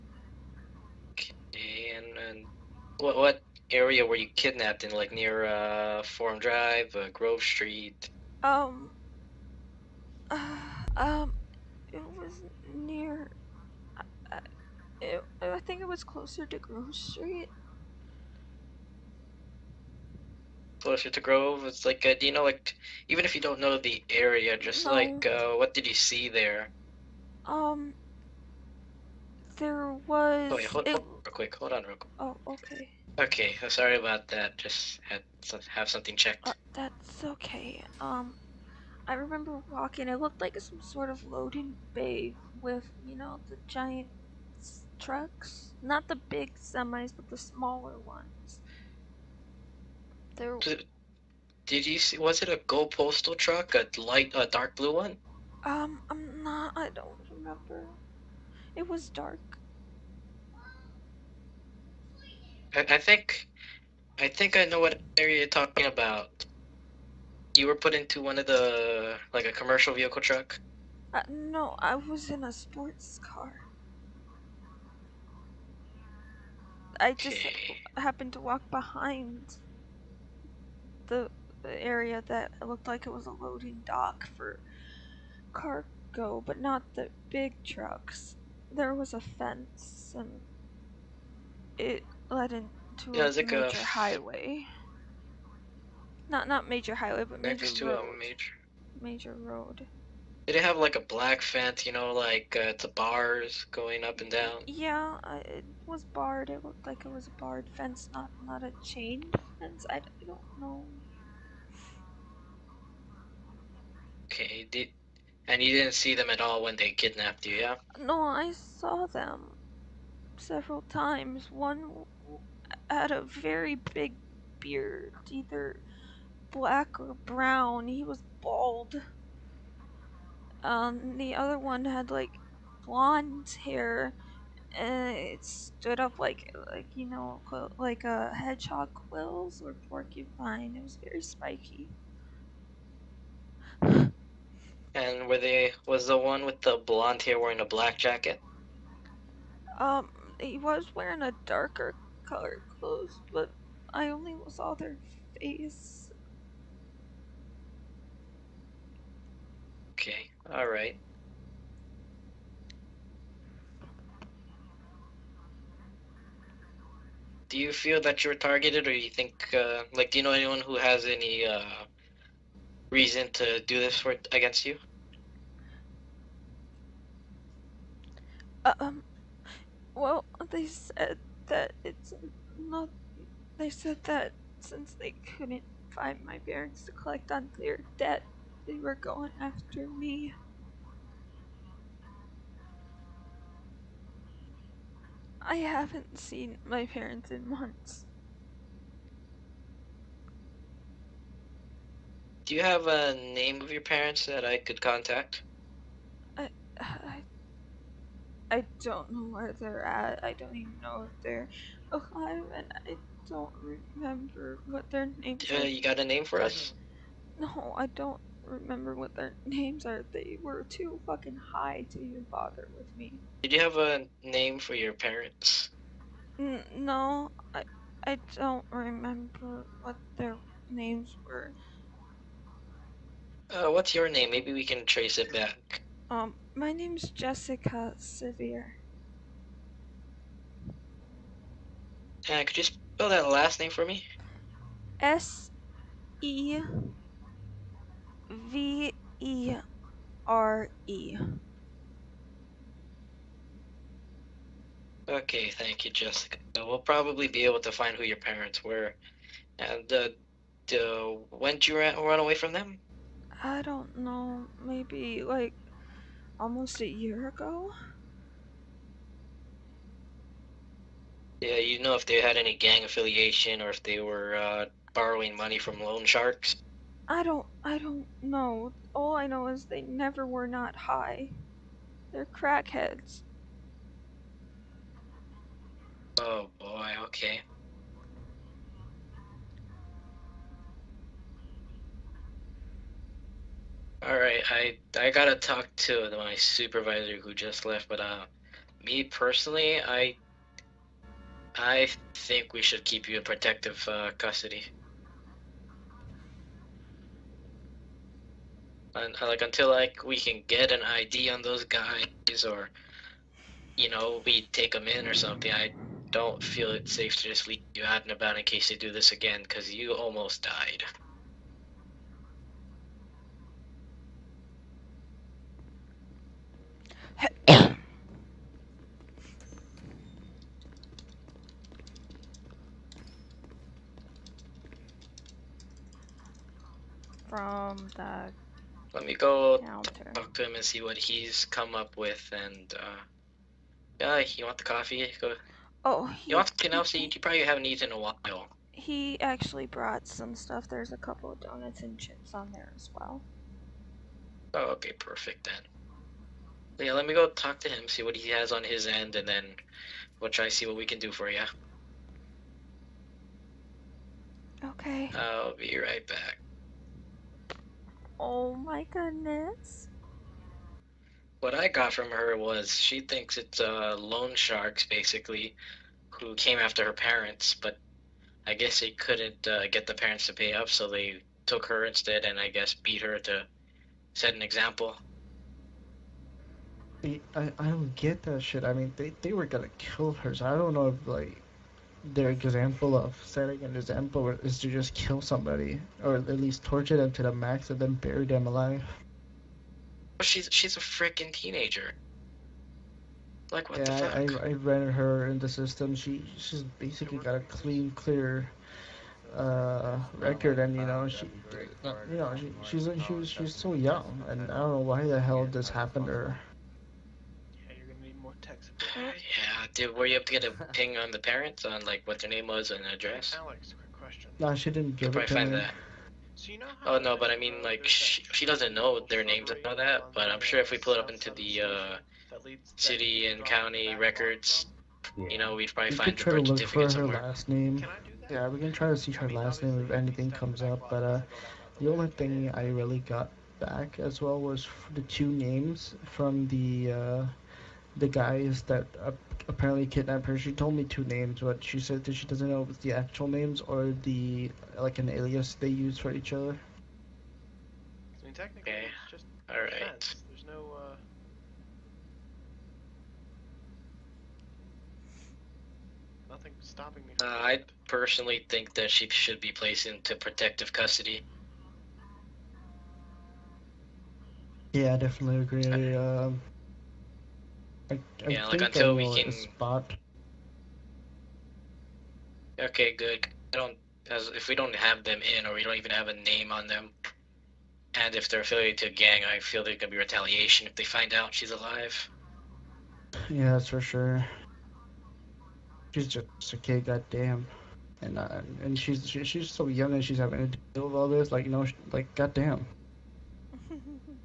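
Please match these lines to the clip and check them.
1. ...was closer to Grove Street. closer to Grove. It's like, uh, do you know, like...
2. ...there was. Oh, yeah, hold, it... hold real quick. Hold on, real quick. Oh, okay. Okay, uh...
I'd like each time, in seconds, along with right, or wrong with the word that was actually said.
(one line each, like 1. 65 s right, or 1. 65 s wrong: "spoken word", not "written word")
1. 15 s right
2. 29 s right.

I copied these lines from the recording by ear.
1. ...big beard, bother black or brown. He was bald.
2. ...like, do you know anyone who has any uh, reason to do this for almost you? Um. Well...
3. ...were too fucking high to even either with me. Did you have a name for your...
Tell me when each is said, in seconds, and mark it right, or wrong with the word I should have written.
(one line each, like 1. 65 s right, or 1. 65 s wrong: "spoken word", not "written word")
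1. 123 s wrong: "either", not "bother"
2. 169 s wrong: "against", not "almost"
3. 220 s wrong: "bother", not "either".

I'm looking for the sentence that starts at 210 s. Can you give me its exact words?
I don't even know if they're alive, and I don't remember what their names uh, are.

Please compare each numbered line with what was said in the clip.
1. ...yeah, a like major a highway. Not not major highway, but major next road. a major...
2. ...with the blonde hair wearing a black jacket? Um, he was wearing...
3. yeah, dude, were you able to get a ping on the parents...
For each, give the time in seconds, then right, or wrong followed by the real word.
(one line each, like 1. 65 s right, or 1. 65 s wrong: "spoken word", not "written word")
1. 93 s right
2. 146 s right
3. 418 s right.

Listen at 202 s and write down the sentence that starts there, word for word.
Do you have a name of your parents that I could contact?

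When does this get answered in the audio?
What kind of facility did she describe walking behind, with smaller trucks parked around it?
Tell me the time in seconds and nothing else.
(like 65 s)
41 s.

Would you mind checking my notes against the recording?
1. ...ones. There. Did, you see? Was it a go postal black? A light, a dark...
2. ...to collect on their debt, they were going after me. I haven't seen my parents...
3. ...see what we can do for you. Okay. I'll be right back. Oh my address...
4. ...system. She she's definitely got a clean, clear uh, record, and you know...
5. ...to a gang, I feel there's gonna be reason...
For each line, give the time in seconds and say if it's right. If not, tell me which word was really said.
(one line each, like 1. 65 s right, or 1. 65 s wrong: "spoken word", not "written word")
1. 47 s wrong: "truck", not "black"
2. 186 s right
3. 360 s wrong: "goodness", not "address"
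4. 405 s wrong: "basically", not "definitely"
5. 488 s wrong: "retaliation", not "reason".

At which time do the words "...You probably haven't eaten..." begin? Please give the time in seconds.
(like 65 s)
346 s.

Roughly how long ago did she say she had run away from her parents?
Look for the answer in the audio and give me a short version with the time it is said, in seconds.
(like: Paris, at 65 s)
almost a year, at 266 s.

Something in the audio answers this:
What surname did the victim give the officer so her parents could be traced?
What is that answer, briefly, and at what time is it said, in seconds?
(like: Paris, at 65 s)
Severe, at 237 s.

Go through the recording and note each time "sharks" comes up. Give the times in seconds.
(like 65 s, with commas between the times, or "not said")
276 s, 374 s.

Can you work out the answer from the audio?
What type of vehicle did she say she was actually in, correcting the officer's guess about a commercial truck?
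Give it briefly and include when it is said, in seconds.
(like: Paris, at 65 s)
sports car, at 72 s.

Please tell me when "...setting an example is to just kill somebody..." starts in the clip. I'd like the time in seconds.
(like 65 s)
393 s.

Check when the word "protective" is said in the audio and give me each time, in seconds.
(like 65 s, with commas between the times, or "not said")
303 s, 470 s.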